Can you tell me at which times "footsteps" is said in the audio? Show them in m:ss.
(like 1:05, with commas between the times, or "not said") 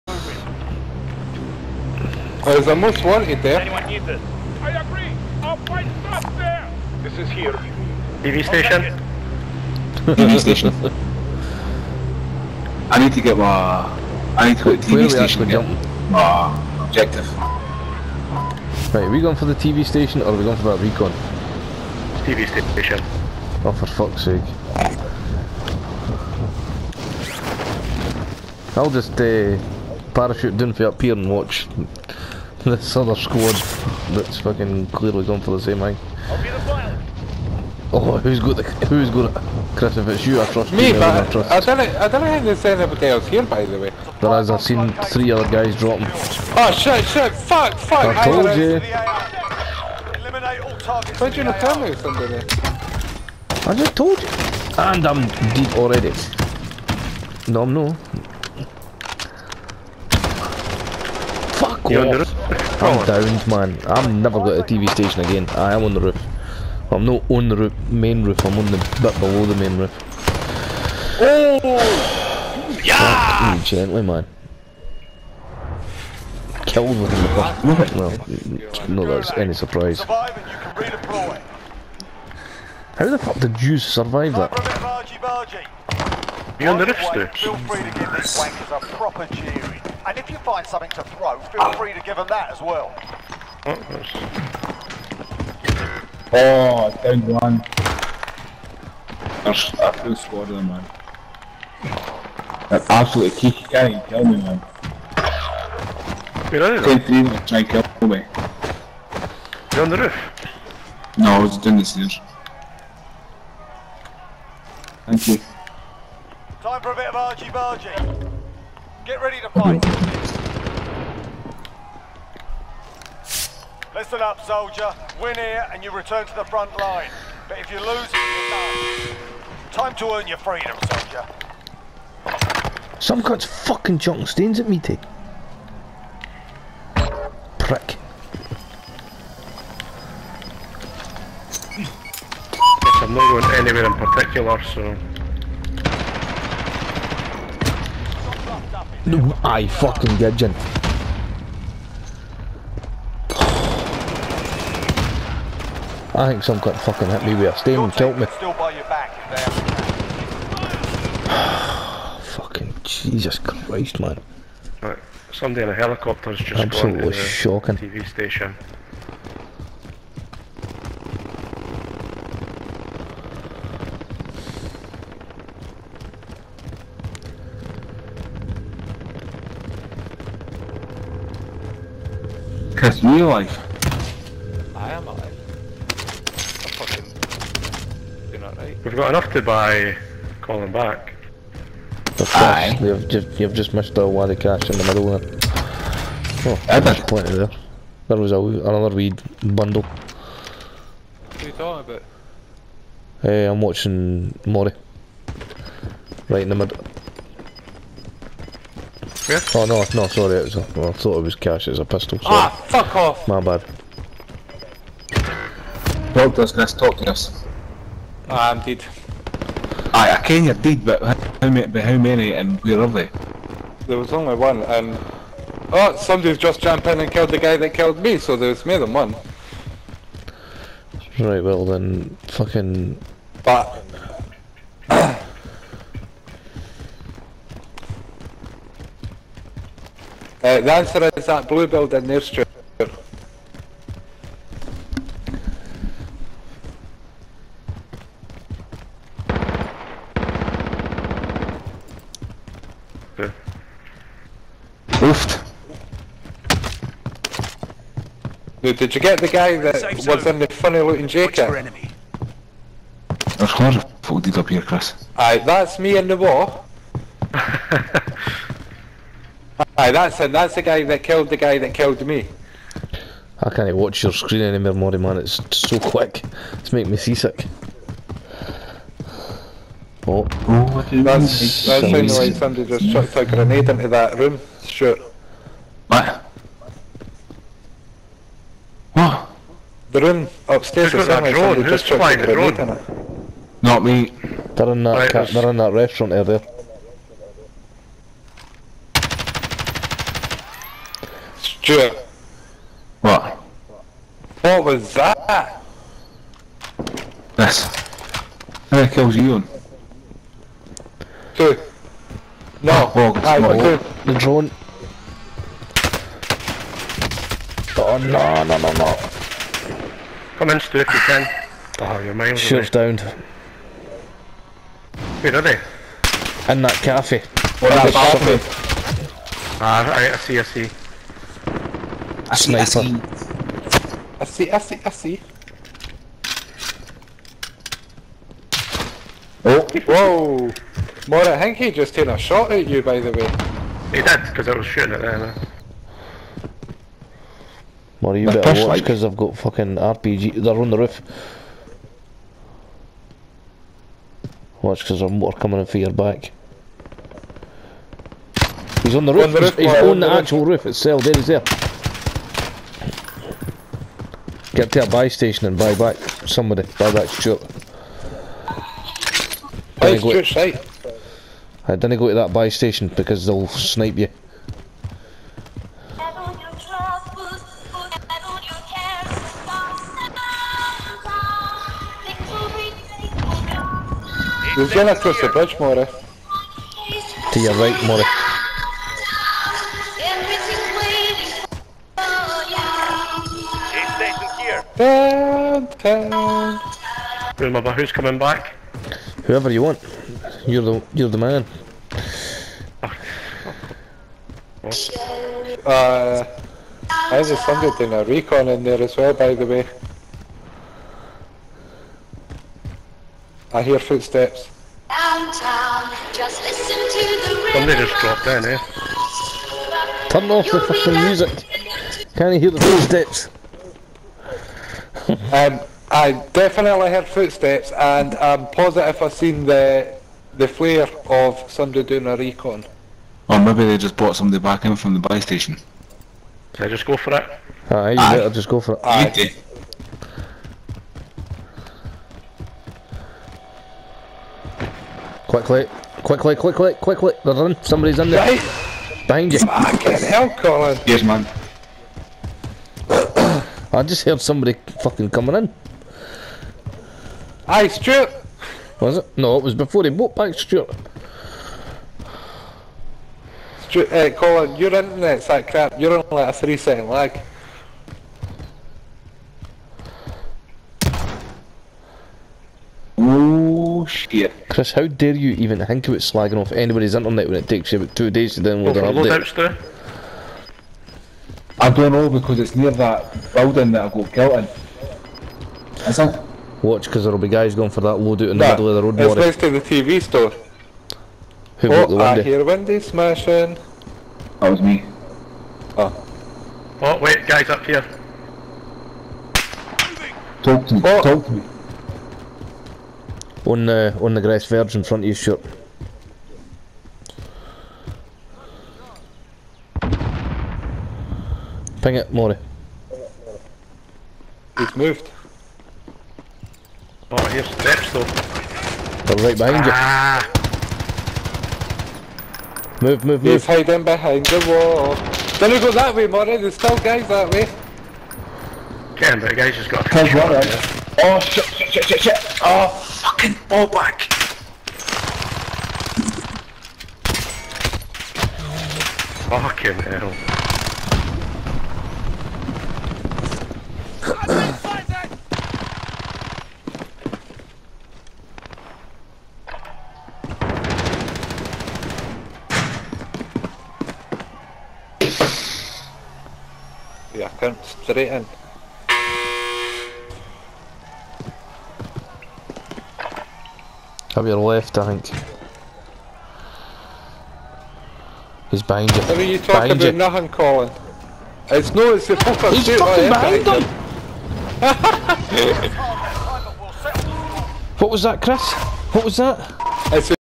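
6:53, 7:02, 7:07.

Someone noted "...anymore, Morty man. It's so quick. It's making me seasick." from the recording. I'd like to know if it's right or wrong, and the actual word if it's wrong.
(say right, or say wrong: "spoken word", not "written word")
right.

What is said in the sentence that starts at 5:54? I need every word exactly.
Watch, because there's more coming in for your back.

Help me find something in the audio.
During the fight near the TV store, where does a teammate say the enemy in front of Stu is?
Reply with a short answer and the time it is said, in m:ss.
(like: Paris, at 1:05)
On the grass verge, at 8:23.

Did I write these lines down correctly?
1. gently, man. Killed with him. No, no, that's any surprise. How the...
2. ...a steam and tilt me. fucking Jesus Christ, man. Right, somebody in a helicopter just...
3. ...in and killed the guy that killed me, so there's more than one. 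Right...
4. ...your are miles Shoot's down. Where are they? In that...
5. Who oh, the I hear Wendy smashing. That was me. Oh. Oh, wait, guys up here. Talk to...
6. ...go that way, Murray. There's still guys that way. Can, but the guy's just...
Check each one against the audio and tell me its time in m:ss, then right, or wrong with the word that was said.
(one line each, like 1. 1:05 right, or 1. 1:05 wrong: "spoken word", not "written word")
1. 1:13 right
2. 2:37 right
3. 3:46 right
4. 5:21 right
5. 8:11 right
6. 8:45 right.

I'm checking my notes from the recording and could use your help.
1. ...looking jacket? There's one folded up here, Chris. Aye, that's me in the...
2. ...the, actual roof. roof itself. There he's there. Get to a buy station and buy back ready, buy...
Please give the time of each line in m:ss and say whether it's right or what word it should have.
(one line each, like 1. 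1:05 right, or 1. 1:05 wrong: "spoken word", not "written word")
1. 4:20 right
2. 6:00 wrong: "somebody", not "ready".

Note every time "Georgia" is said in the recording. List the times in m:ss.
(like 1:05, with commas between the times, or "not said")
not said.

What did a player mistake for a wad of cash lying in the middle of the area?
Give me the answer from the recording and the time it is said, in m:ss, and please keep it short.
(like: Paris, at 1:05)
A pistol, at 3:31.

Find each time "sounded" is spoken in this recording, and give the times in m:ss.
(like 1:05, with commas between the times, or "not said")
4:41, 4:51.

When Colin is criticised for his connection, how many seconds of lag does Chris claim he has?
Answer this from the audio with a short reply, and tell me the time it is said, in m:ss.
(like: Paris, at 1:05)
3, at 7:46.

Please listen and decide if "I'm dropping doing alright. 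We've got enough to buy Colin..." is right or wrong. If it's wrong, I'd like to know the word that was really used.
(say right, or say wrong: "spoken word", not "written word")
wrong: "fucking", not "dropping".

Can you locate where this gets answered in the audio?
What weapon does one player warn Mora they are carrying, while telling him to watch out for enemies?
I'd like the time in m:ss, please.
5:49.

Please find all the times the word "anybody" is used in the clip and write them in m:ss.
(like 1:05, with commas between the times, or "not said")
0:42, 7:56.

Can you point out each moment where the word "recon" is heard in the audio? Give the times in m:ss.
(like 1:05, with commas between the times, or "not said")
0:20, 6:48, 7:12.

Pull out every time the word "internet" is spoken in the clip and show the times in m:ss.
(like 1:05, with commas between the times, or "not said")
7:44, 7:56.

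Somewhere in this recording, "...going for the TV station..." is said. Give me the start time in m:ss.
0:19.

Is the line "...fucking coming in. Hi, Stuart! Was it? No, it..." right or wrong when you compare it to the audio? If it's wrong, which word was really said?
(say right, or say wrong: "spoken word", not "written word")
right.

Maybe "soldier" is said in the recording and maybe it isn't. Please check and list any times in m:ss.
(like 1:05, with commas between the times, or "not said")
2:04, 2:10.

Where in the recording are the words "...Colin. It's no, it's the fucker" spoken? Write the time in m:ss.
9:30.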